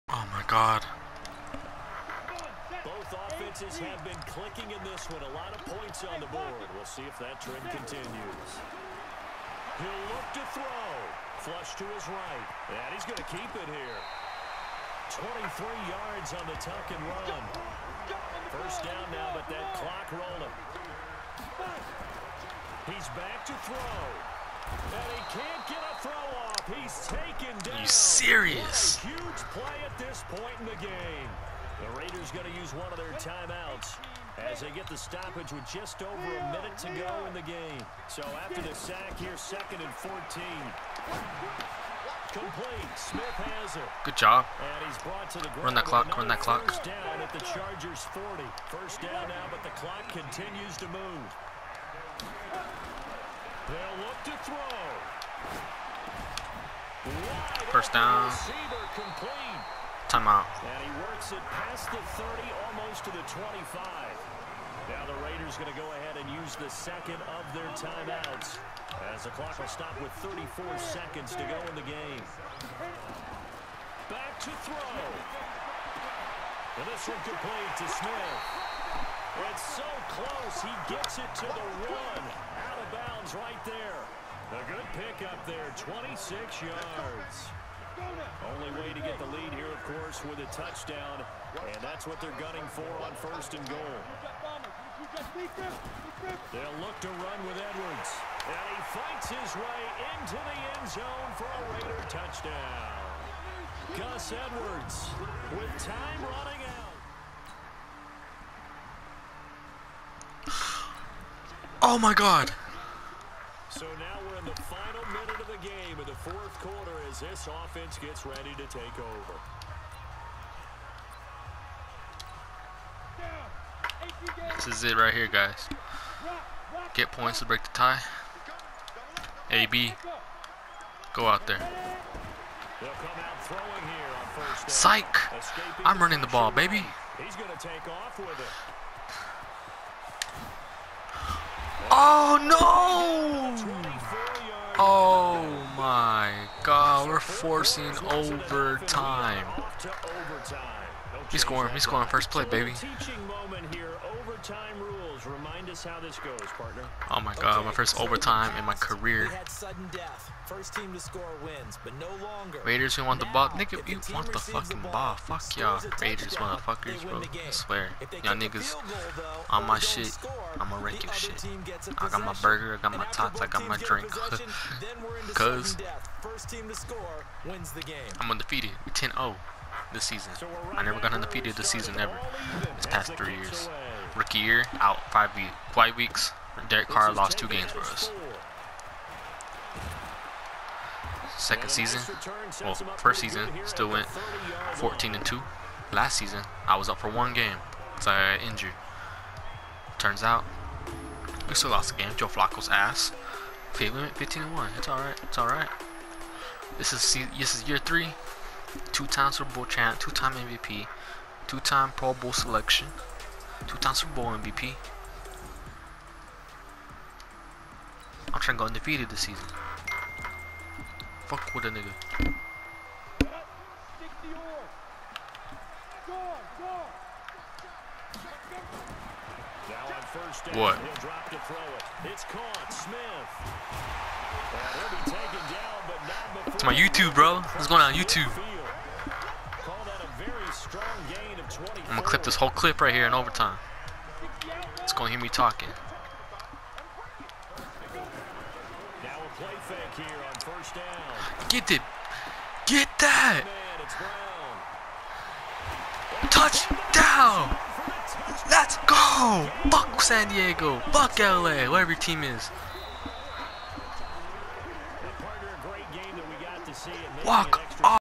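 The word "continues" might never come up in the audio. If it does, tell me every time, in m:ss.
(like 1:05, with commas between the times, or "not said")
0:07, 0:50.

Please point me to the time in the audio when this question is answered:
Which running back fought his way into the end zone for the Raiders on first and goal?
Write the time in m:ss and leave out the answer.
1:43.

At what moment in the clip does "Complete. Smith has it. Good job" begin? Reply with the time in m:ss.
0:42.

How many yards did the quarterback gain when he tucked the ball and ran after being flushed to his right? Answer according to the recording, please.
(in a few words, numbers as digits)
23.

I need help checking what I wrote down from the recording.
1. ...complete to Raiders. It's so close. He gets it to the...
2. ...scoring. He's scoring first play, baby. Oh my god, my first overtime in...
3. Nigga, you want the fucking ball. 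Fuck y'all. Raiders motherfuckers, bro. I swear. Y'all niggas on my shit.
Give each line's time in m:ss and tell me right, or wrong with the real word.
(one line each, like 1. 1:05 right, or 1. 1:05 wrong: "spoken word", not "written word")
1. 1:17 wrong: "Smith", not "Raiders"
2. 2:31 right
3. 2:43 right.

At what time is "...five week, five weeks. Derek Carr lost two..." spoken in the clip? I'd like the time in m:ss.
3:05.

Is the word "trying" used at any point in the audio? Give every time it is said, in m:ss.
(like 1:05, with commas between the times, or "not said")
3:38.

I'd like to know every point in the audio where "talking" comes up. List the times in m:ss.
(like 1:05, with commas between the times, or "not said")
4:05.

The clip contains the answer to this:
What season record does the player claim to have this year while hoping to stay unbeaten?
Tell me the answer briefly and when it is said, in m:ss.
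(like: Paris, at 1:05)
10-0, at 2:58.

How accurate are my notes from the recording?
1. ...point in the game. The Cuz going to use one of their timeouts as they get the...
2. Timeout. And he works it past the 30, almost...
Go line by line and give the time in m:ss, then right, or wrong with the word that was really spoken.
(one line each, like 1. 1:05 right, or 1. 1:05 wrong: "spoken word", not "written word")
1. 0:30 wrong: "Raiders", not "Cuz"
2. 1:00 right.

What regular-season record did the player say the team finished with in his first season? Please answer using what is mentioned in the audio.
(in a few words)
14 and 2.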